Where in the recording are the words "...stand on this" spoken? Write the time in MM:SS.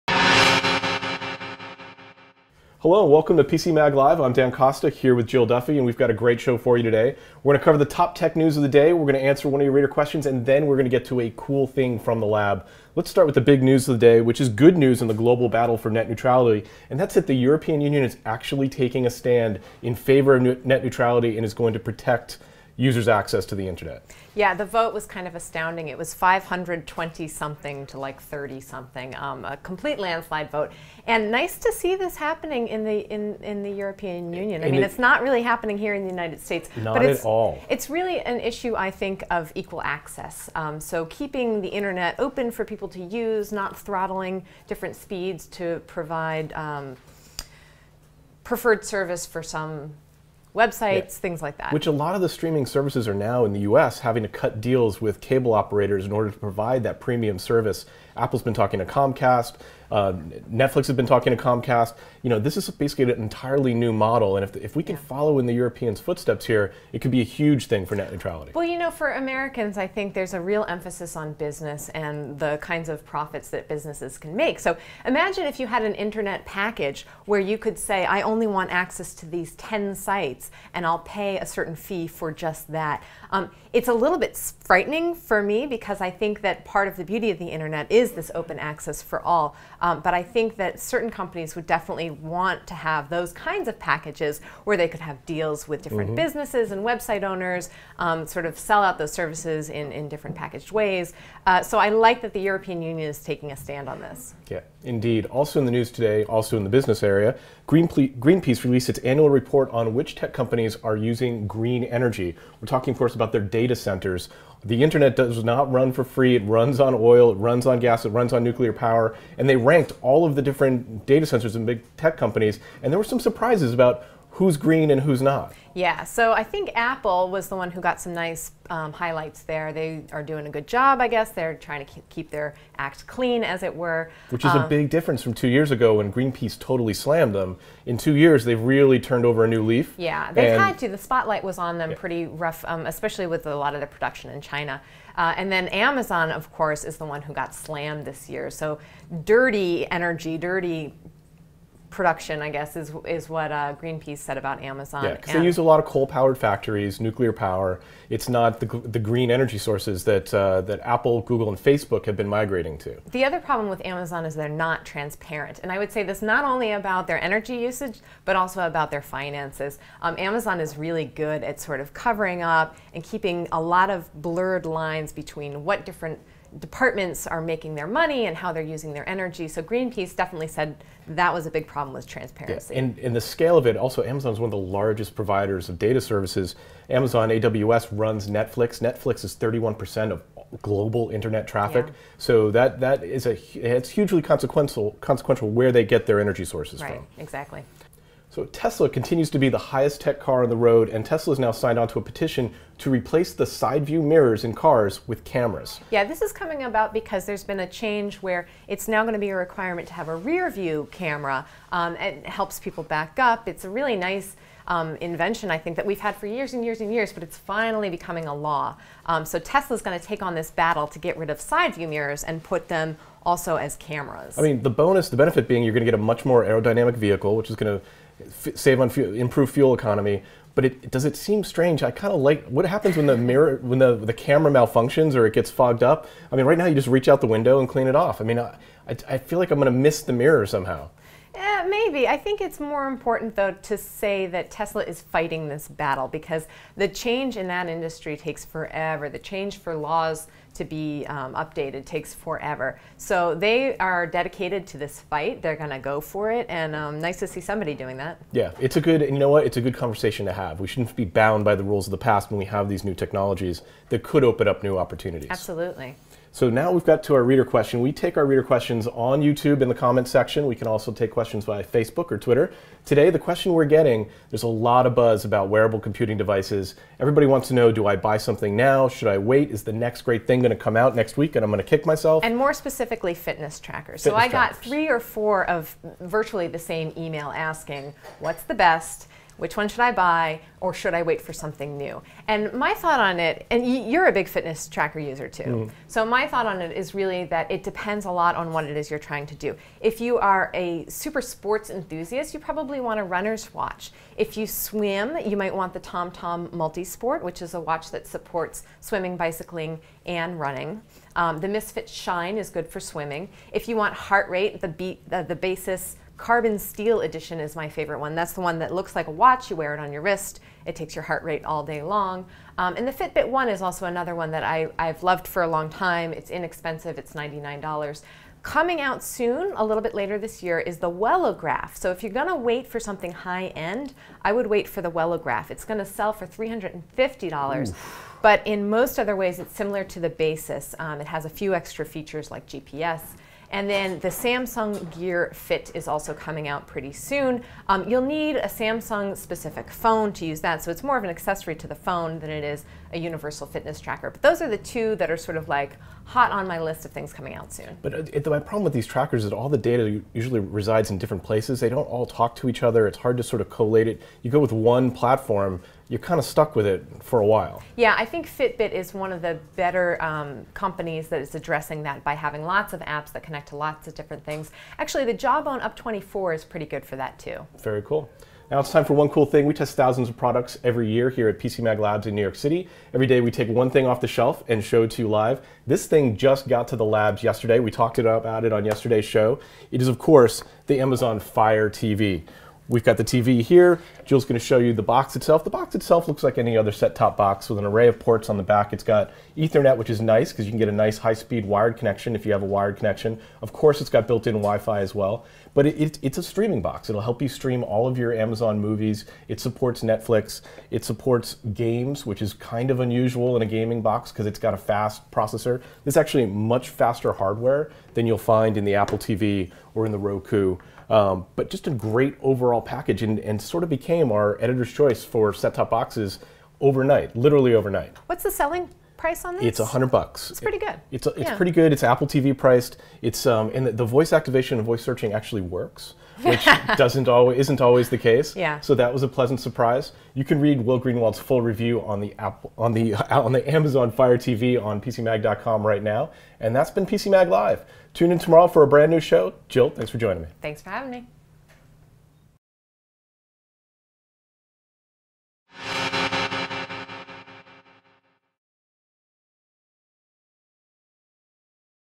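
01:43.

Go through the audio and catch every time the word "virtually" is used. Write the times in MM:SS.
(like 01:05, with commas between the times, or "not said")
04:45.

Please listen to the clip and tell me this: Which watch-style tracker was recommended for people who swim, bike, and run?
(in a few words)
TomTom Multisport.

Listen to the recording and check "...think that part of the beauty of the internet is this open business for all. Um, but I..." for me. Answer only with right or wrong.
wrong.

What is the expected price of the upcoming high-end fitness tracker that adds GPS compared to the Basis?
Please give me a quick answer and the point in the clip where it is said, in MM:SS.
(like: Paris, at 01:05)
$350, at 05:36.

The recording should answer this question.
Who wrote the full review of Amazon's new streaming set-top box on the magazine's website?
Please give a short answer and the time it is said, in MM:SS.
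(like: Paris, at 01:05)
Will Greenwald, at 07:20.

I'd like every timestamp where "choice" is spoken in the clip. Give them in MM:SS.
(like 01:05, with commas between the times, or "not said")
07:04.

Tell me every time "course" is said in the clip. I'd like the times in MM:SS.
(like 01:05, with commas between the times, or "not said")
01:52, 02:26, 06:29, 06:43.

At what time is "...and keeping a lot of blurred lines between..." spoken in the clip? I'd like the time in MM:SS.
02:52.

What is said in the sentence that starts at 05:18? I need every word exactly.
That's the one that looks like a watch.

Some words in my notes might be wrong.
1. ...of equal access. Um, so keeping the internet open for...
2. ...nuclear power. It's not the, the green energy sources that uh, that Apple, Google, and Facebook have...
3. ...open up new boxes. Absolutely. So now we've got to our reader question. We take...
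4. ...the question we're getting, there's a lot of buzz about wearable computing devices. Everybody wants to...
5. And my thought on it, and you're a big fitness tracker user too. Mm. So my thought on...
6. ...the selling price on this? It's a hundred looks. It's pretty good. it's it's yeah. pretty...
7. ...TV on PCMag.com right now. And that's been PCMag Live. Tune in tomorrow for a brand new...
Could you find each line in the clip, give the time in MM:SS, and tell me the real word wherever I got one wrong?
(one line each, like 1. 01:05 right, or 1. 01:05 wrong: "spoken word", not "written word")
1. 00:39 right
2. 02:36 right
3. 04:24 wrong: "opportunities", not "boxes"
4. 04:33 right
5. 04:52 right
6. 07:08 wrong: "bucks", not "looks"
7. 07:24 right.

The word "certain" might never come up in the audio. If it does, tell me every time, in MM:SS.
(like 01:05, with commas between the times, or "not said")
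01:21, 01:30.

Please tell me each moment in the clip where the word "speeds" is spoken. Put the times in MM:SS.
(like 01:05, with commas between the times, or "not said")
00:44, 06:40.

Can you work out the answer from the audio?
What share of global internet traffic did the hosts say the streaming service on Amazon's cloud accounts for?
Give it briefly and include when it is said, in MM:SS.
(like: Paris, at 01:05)
31%, at 03:09.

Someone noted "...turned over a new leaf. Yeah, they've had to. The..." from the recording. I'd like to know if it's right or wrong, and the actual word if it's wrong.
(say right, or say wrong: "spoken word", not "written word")
right.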